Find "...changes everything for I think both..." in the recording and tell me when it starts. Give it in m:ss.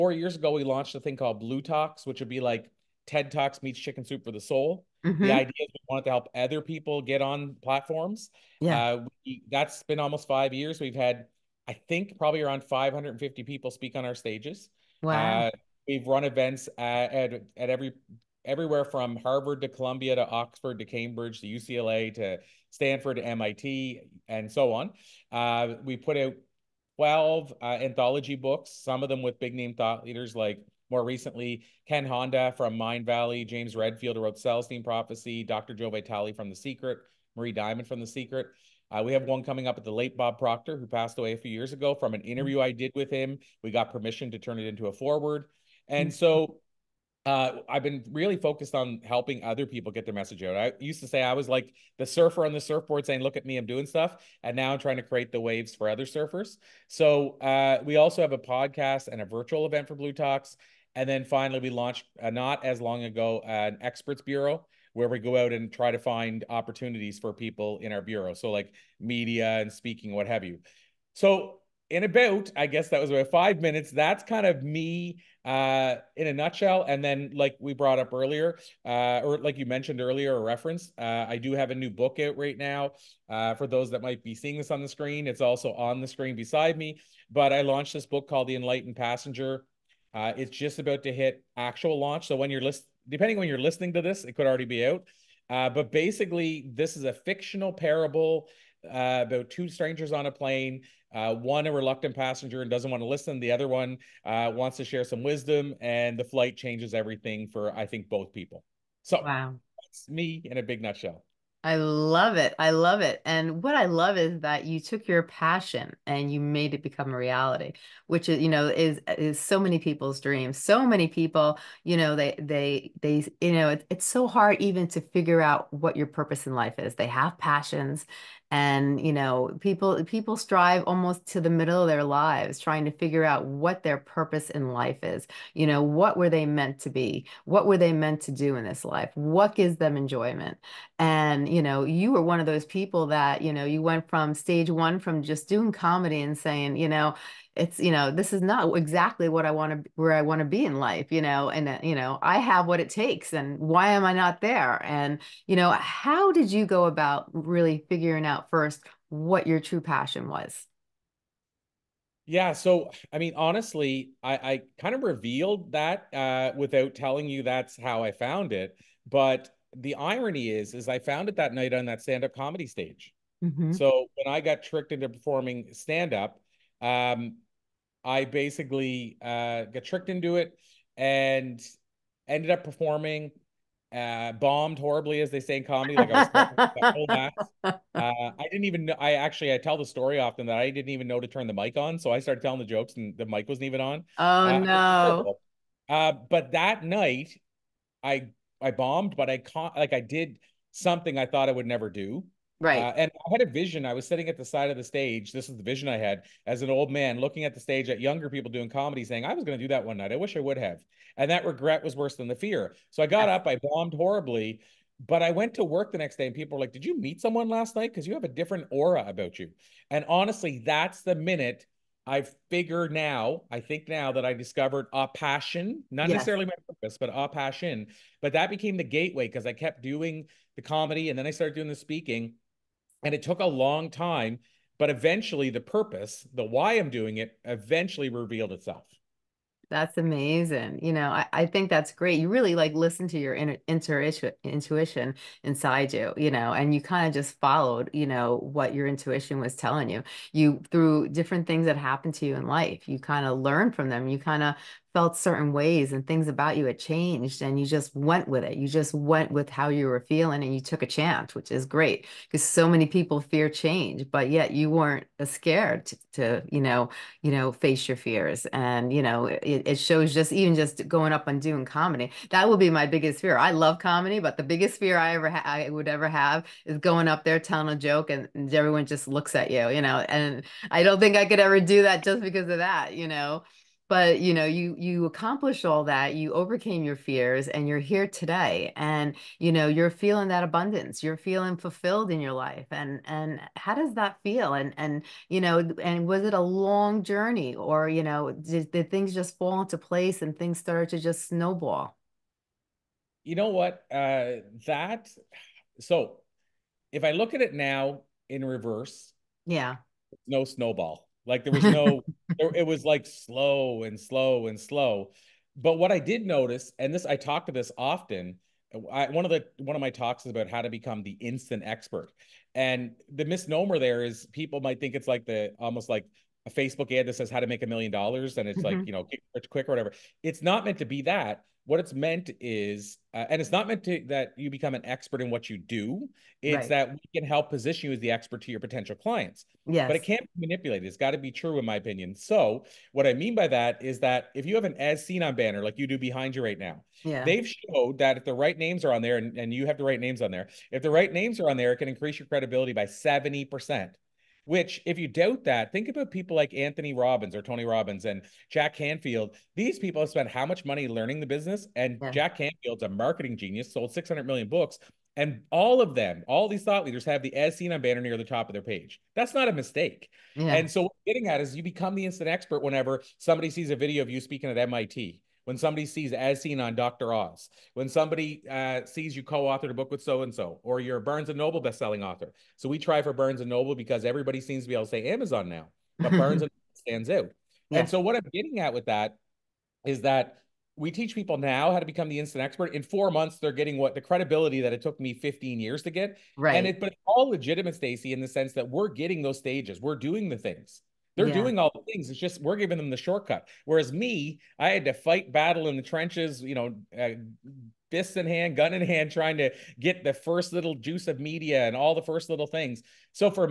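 1:46.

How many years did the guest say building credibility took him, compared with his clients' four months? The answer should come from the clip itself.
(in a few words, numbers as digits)
15.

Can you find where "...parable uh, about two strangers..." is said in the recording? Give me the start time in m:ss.
1:37.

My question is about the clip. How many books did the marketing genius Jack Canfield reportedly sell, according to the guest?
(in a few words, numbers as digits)
600 million.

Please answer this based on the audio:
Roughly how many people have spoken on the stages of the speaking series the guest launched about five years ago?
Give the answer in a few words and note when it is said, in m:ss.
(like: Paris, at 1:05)
550, at 0:12.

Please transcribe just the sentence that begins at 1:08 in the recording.
So like media and speaking, what have you.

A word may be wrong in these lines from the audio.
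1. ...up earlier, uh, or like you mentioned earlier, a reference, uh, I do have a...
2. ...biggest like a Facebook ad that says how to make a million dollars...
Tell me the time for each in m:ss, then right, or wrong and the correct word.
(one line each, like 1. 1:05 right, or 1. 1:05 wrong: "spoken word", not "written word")
1. 1:17 right
2. 5:25 wrong: "almost", not "biggest".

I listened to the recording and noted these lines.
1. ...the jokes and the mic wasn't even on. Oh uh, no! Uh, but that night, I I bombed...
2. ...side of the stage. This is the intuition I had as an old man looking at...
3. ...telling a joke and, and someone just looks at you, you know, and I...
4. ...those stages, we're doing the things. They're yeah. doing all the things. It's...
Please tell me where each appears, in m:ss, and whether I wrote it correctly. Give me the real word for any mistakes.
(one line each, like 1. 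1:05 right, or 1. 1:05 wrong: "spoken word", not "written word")
1. 3:12 right
2. 3:24 wrong: "vision", not "intuition"
3. 4:37 wrong: "everyone", not "someone"
4. 6:39 right.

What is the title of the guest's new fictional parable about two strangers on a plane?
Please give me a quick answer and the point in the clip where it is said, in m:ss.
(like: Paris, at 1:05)
The Enlightened Passenger, at 1:28.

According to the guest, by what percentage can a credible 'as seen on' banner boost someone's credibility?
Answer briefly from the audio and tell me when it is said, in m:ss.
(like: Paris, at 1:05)
70%, at 5:52.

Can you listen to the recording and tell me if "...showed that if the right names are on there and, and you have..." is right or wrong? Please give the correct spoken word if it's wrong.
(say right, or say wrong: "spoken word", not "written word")
right.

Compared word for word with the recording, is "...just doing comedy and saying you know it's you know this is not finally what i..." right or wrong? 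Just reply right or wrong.
wrong.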